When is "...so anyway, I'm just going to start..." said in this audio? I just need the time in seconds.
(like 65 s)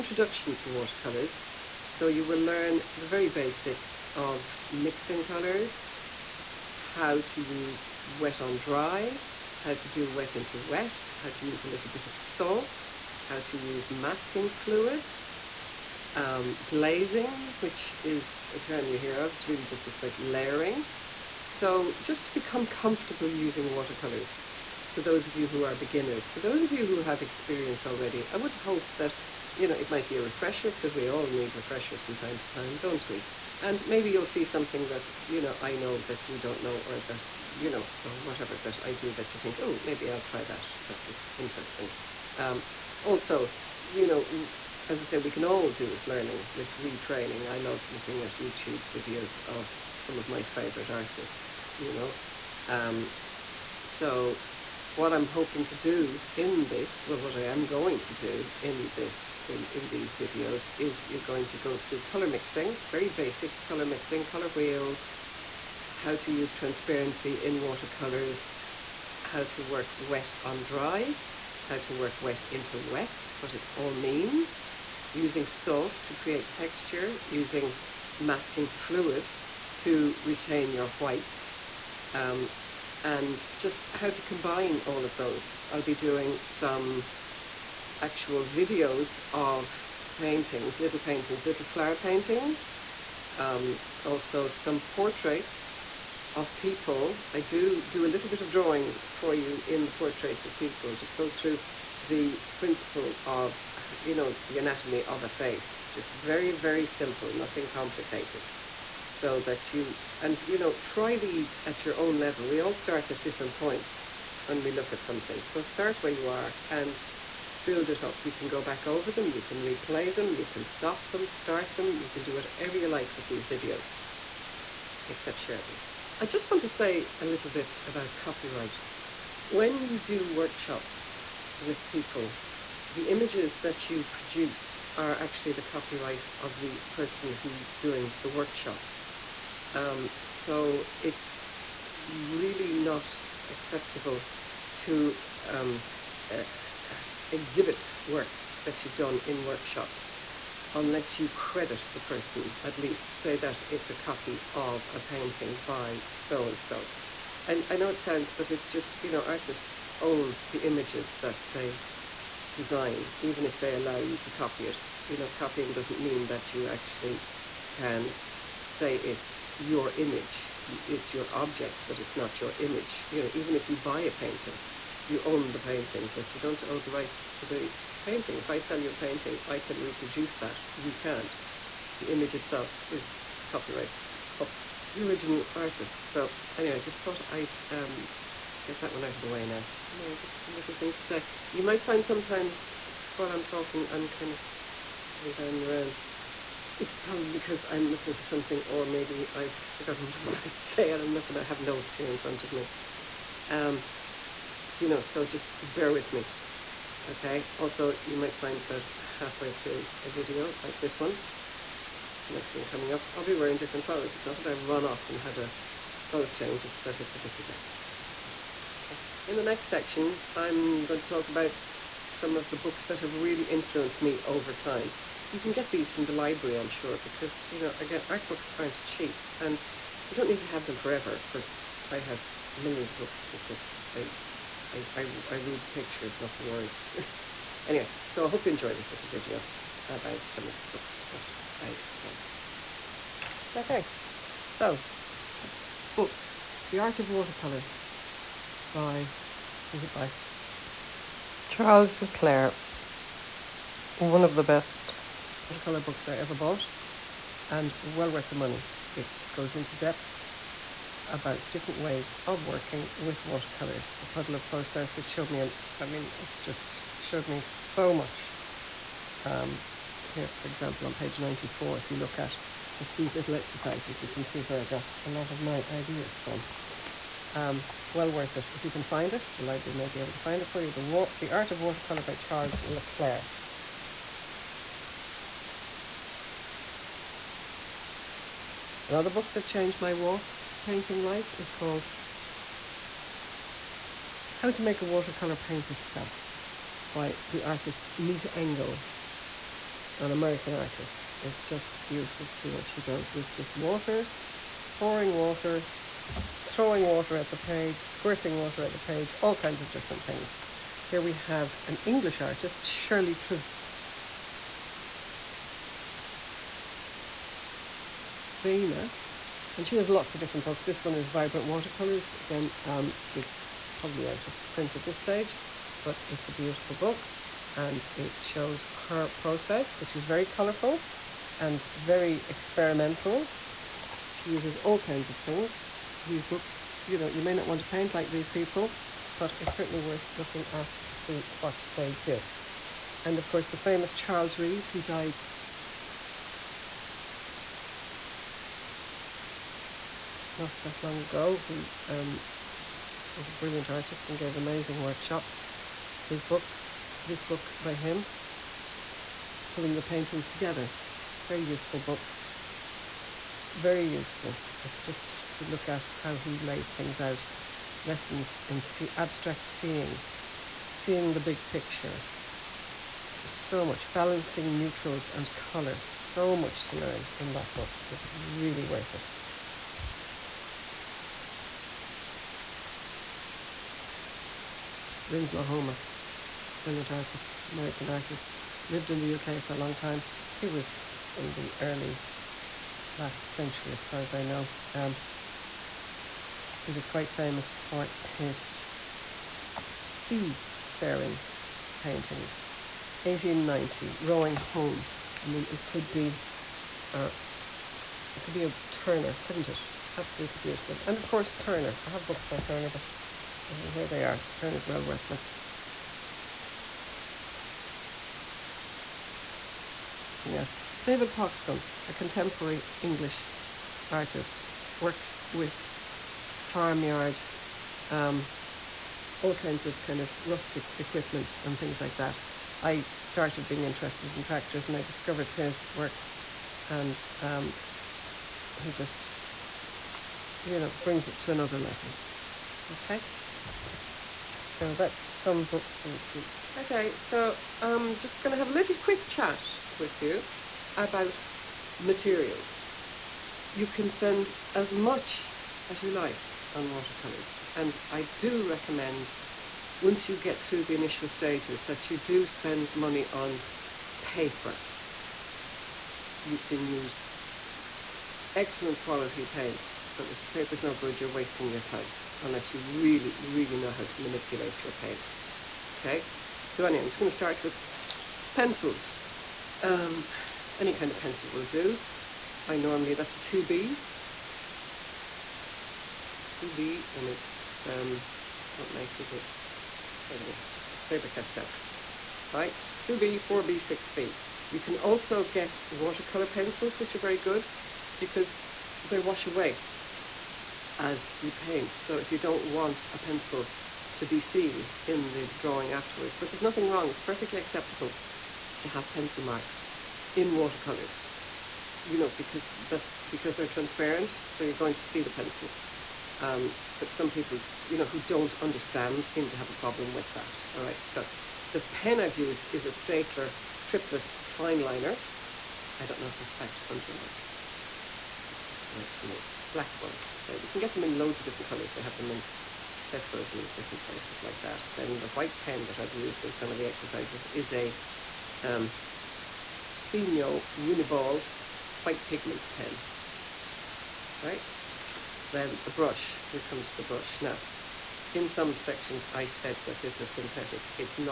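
476 s.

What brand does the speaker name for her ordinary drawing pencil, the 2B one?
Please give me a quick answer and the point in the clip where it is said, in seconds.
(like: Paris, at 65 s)
Faber-Castell, at 490 s.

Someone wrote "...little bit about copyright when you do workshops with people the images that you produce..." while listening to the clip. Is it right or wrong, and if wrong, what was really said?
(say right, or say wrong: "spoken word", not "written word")
right.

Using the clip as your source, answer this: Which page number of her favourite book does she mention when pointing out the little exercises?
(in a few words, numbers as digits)
94.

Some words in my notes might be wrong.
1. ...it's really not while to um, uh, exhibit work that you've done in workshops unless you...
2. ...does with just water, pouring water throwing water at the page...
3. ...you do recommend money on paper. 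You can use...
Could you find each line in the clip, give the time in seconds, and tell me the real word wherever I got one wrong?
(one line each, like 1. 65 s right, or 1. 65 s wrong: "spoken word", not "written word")
1. 141 s wrong: "acceptable", not "while"
2. 302 s right
3. 461 s wrong: "spend", not "recommend".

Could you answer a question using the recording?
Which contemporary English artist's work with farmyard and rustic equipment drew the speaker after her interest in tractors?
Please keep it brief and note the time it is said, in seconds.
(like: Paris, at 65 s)
David Poxon, at 420 s.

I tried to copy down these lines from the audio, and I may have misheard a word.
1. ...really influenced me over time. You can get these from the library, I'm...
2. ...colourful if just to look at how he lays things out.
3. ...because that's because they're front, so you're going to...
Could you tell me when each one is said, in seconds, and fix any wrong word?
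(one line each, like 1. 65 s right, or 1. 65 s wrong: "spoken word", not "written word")
1. 223 s right
2. 363 s wrong: "useful", not "colourful"
3. 512 s wrong: "transparent", not "front".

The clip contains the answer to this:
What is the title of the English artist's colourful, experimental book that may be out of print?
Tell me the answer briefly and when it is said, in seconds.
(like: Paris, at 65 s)
Vibrant Watercolors, at 321 s.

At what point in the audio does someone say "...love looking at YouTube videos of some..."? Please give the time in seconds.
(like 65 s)
47 s.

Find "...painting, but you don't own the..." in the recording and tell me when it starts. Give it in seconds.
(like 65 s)
175 s.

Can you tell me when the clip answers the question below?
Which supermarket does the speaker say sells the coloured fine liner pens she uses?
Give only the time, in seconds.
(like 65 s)
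532 s.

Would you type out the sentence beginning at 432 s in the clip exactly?
I started being interested in tractors and I discovered his work and um, he just, you know, brings it to another level.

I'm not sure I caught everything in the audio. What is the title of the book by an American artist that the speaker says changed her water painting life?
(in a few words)
How to Make a Watercolour Paint Itself.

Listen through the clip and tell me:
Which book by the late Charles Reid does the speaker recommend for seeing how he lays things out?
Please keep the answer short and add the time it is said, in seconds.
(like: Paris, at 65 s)
Pulling Your Paintings Together, at 359 s.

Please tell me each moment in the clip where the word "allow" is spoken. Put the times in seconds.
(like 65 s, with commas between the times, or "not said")
163 s.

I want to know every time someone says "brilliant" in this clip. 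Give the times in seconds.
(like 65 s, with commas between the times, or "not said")
353 s, 386 s.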